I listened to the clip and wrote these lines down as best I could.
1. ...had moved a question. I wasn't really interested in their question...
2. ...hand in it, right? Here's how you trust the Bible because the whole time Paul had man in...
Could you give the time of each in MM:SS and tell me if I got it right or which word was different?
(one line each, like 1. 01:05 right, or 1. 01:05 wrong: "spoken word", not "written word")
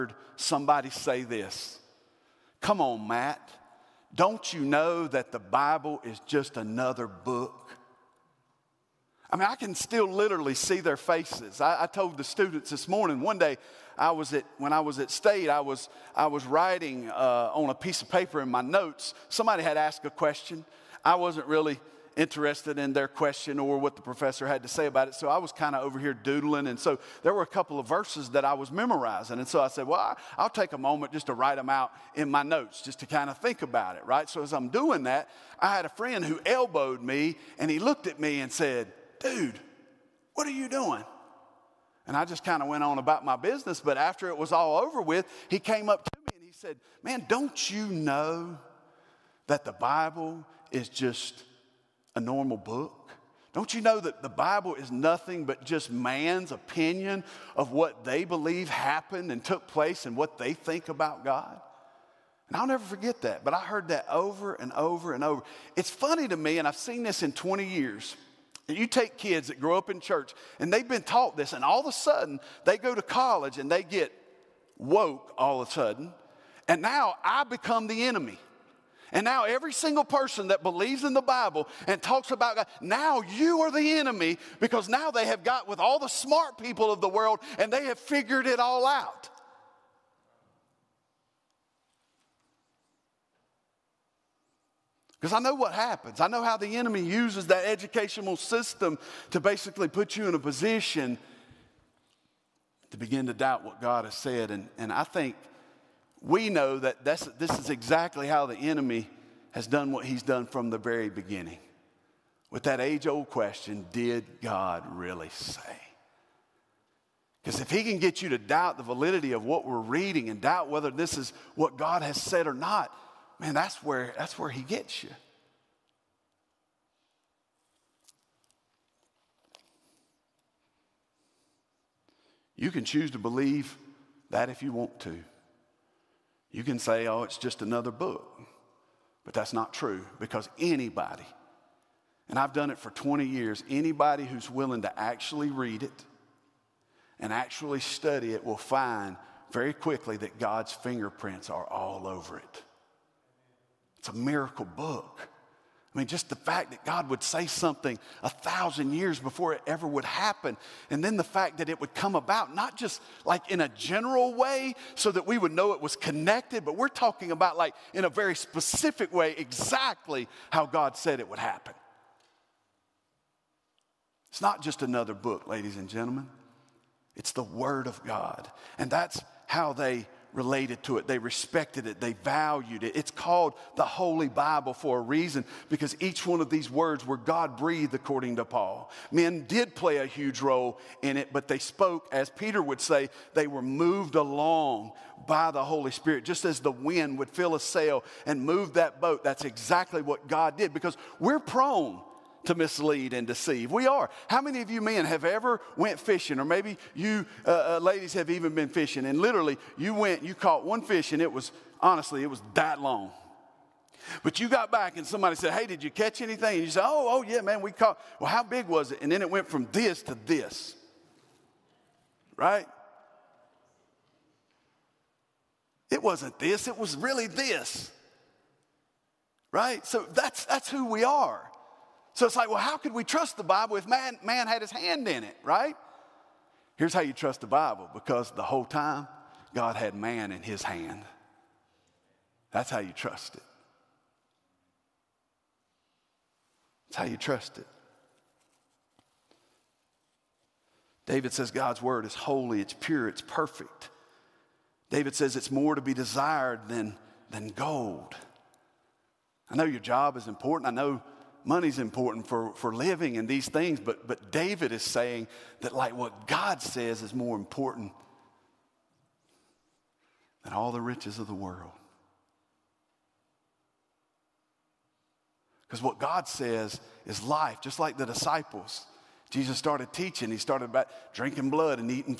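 1. 00:19 wrong: "asked", not "moved"
2. 03:54 wrong: "God", not "Paul".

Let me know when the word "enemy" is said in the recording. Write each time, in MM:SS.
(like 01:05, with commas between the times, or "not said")
01:18, 01:23, 01:36, 01:48.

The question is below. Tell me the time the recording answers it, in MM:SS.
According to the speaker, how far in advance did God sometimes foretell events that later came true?
02:38.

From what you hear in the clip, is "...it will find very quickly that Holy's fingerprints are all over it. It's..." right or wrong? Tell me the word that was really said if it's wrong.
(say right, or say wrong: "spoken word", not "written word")
wrong: "God", not "Holy".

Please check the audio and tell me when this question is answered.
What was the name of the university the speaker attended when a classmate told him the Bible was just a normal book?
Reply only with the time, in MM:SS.
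00:15.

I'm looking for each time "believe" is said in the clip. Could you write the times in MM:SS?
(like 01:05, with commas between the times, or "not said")
00:58, 01:20, 02:13.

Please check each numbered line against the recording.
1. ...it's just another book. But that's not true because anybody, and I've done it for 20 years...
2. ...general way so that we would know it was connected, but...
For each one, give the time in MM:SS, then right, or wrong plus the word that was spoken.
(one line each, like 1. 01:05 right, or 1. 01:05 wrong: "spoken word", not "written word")
1. 02:17 right
2. 02:43 right.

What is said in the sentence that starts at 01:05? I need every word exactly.
It's funny to me, and I've seen this in 20 years.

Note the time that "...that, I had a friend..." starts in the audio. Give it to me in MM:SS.
00:35.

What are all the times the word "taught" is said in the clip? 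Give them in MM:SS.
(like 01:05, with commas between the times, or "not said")
01:11.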